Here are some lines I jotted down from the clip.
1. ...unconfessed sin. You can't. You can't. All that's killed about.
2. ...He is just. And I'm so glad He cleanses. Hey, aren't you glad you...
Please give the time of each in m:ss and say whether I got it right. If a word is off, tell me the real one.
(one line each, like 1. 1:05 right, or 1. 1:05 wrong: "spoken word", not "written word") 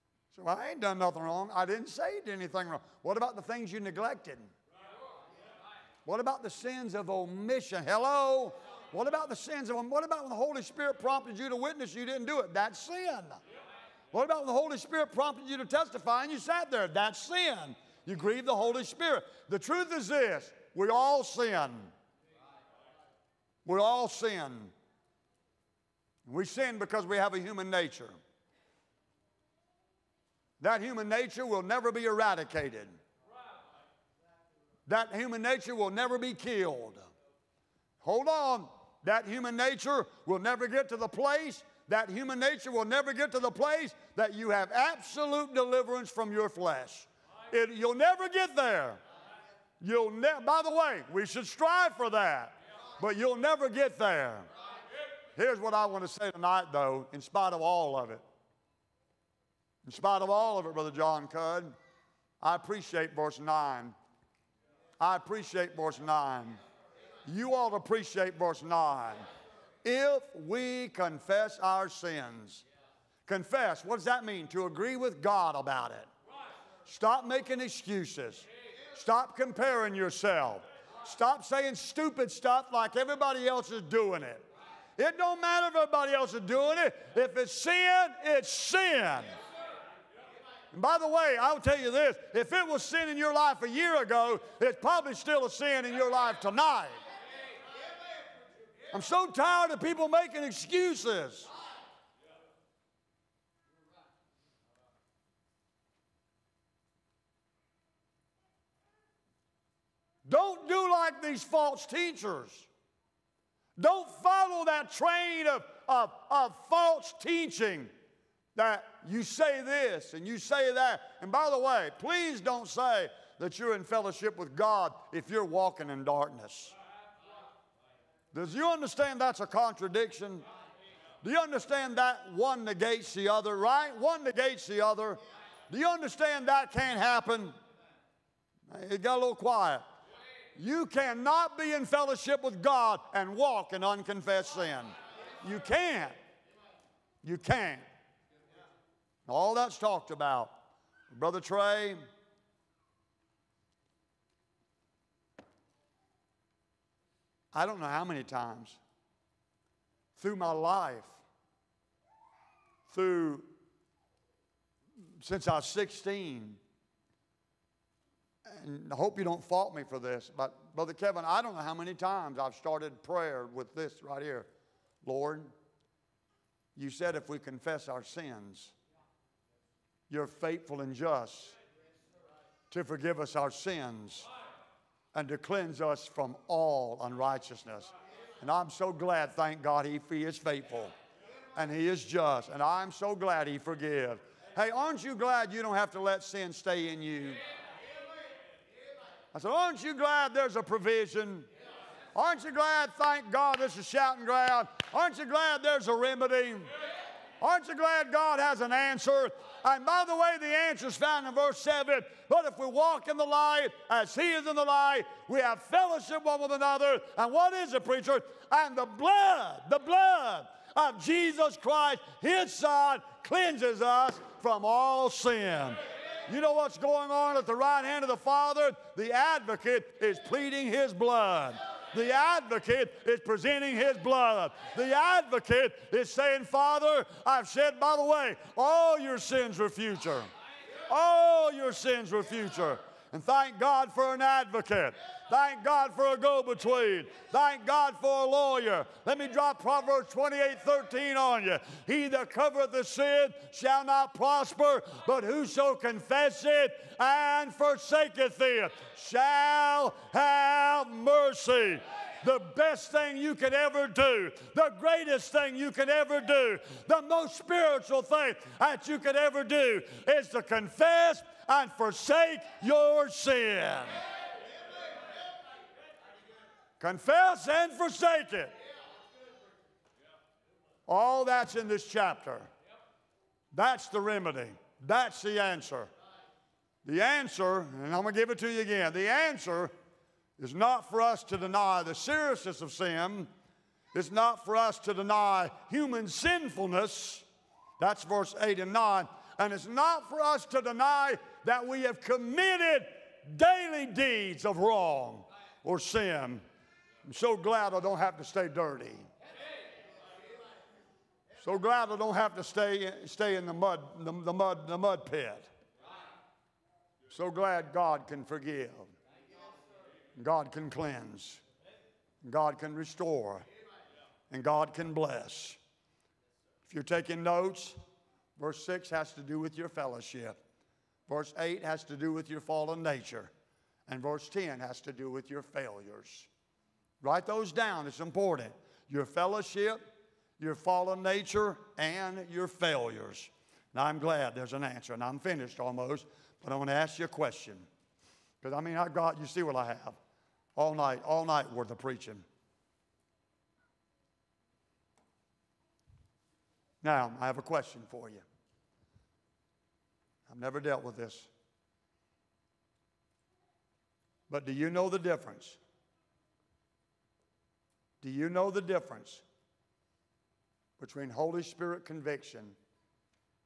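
1. 2:23 wrong: "talked", not "killed"
2. 3:11 wrong: "forgives", not "cleanses".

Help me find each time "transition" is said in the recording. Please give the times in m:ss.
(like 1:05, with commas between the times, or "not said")
not said.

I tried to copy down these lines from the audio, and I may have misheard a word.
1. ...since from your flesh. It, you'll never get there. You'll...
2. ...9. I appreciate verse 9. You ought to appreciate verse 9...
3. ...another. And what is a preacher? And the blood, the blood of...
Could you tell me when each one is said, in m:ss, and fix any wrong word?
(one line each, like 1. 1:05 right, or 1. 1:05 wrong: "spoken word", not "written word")
1. 0:45 wrong: "deliverance", not "since"
2. 1:03 right
3. 3:36 right.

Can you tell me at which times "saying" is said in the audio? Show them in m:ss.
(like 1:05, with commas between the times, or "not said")
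1:21, 3:56.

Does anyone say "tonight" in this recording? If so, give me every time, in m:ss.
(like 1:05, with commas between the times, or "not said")
0:56, 1:36.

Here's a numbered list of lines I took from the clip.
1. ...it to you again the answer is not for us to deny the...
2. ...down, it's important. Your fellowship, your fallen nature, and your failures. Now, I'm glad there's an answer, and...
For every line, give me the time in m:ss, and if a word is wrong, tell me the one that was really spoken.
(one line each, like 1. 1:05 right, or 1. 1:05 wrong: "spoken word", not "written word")
1. 4:48 right
2. 5:37 right.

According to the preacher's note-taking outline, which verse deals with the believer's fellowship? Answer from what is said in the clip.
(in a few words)
Verse 6.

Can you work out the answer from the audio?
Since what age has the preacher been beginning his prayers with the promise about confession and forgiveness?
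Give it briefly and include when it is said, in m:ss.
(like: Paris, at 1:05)
16, at 2:45.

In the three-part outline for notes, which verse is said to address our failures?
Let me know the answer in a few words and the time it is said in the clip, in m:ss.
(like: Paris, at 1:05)
Verse 10, at 5:34.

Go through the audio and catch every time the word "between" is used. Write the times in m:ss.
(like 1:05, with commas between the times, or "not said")
4:06, 6:10.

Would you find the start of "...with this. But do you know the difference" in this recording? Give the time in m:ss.
6:00.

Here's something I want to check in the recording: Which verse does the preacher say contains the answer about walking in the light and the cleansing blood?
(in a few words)
Verse 7.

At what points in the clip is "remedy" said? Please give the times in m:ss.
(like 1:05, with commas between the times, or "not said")
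3:25, 4:43.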